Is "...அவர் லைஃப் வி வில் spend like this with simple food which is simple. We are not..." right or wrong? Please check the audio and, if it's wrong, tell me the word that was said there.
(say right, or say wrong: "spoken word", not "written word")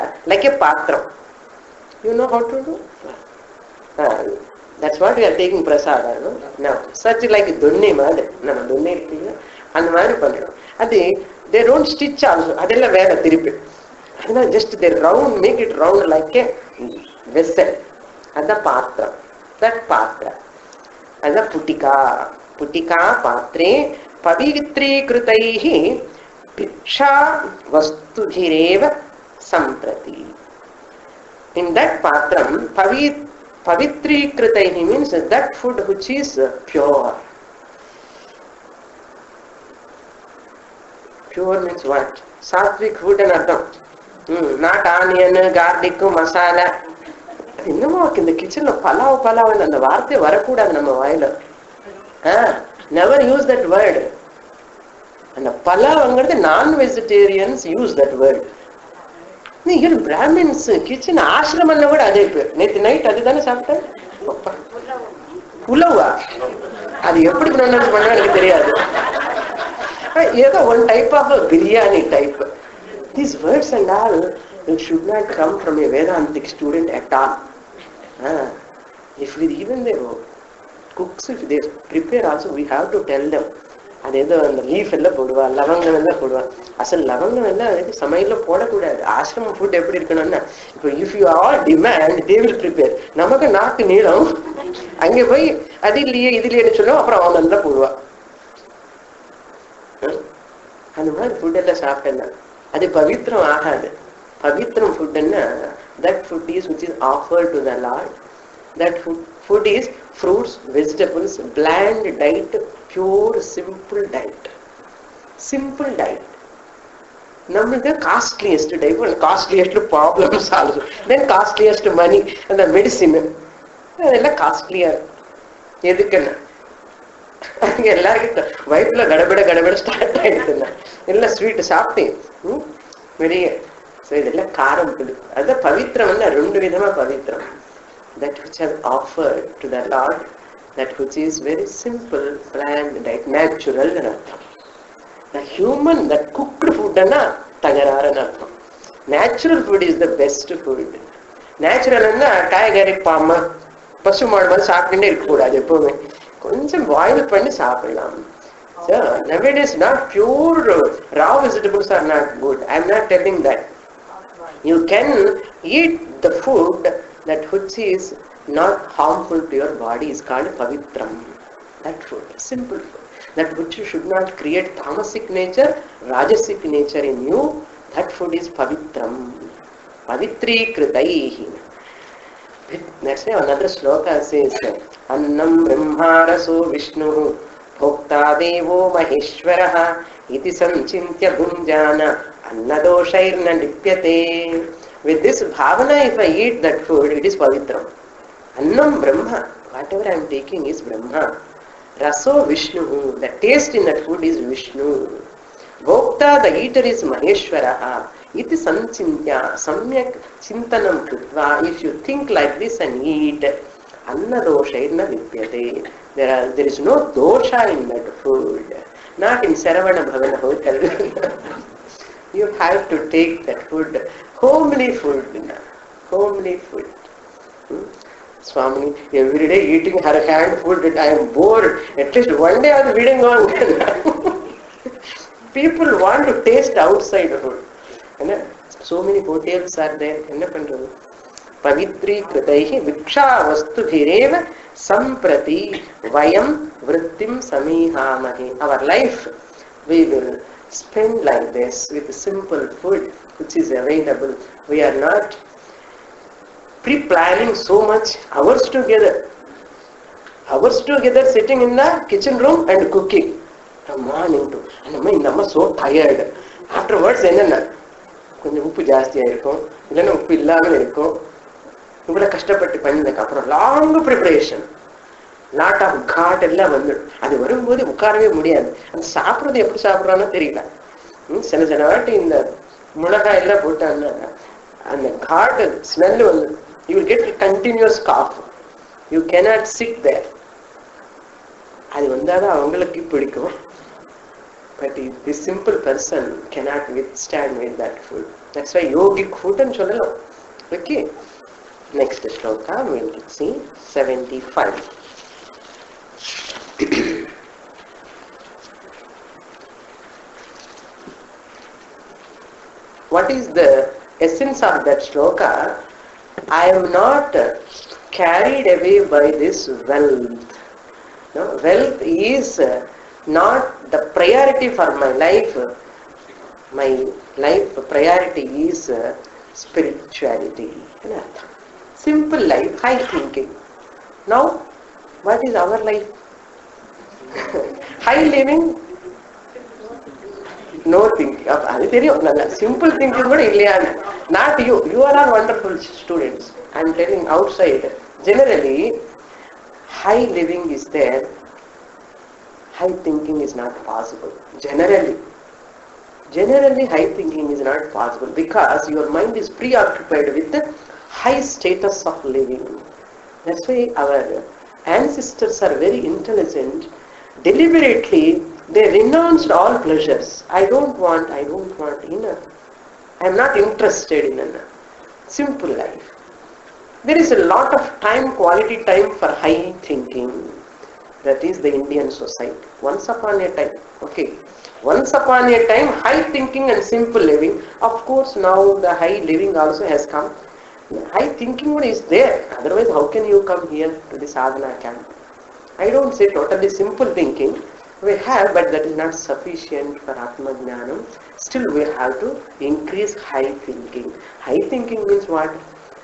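wrong: "available", not "simple".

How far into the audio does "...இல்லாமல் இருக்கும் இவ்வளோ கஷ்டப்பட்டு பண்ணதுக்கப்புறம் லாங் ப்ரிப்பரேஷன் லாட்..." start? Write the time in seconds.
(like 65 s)
270 s.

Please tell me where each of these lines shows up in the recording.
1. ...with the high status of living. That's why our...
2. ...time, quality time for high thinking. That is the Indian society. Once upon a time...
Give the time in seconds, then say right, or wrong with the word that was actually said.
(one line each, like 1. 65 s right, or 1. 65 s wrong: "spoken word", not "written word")
1. 360 s right
2. 378 s right.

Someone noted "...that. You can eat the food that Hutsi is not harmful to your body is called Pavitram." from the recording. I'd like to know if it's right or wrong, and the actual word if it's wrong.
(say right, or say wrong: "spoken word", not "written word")
right.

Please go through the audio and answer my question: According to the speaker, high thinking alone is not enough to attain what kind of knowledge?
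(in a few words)
Atma Jnanam.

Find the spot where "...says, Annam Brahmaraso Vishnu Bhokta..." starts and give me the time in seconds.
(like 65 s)
184 s.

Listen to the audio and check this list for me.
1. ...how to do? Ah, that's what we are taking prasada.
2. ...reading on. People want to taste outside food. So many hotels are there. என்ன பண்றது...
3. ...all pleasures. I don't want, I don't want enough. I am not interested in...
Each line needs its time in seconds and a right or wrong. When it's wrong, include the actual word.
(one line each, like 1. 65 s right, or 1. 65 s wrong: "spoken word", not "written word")
1. 2 s right
2. 232 s right
3. 369 s right.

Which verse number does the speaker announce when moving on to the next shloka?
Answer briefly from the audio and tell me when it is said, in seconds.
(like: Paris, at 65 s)
75, at 303 s.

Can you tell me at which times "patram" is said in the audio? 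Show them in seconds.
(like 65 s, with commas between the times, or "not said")
0 s, 32 s.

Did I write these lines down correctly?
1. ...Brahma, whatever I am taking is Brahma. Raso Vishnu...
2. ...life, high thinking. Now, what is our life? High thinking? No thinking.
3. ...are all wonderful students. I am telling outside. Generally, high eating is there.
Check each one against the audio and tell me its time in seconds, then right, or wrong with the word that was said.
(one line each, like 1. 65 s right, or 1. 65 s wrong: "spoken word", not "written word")
1. 199 s right
2. 332 s wrong: "living", not "thinking"
3. 345 s wrong: "living", not "eating".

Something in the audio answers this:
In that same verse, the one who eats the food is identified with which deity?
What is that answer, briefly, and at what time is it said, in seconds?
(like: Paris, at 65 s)
Maheshwara, at 207 s.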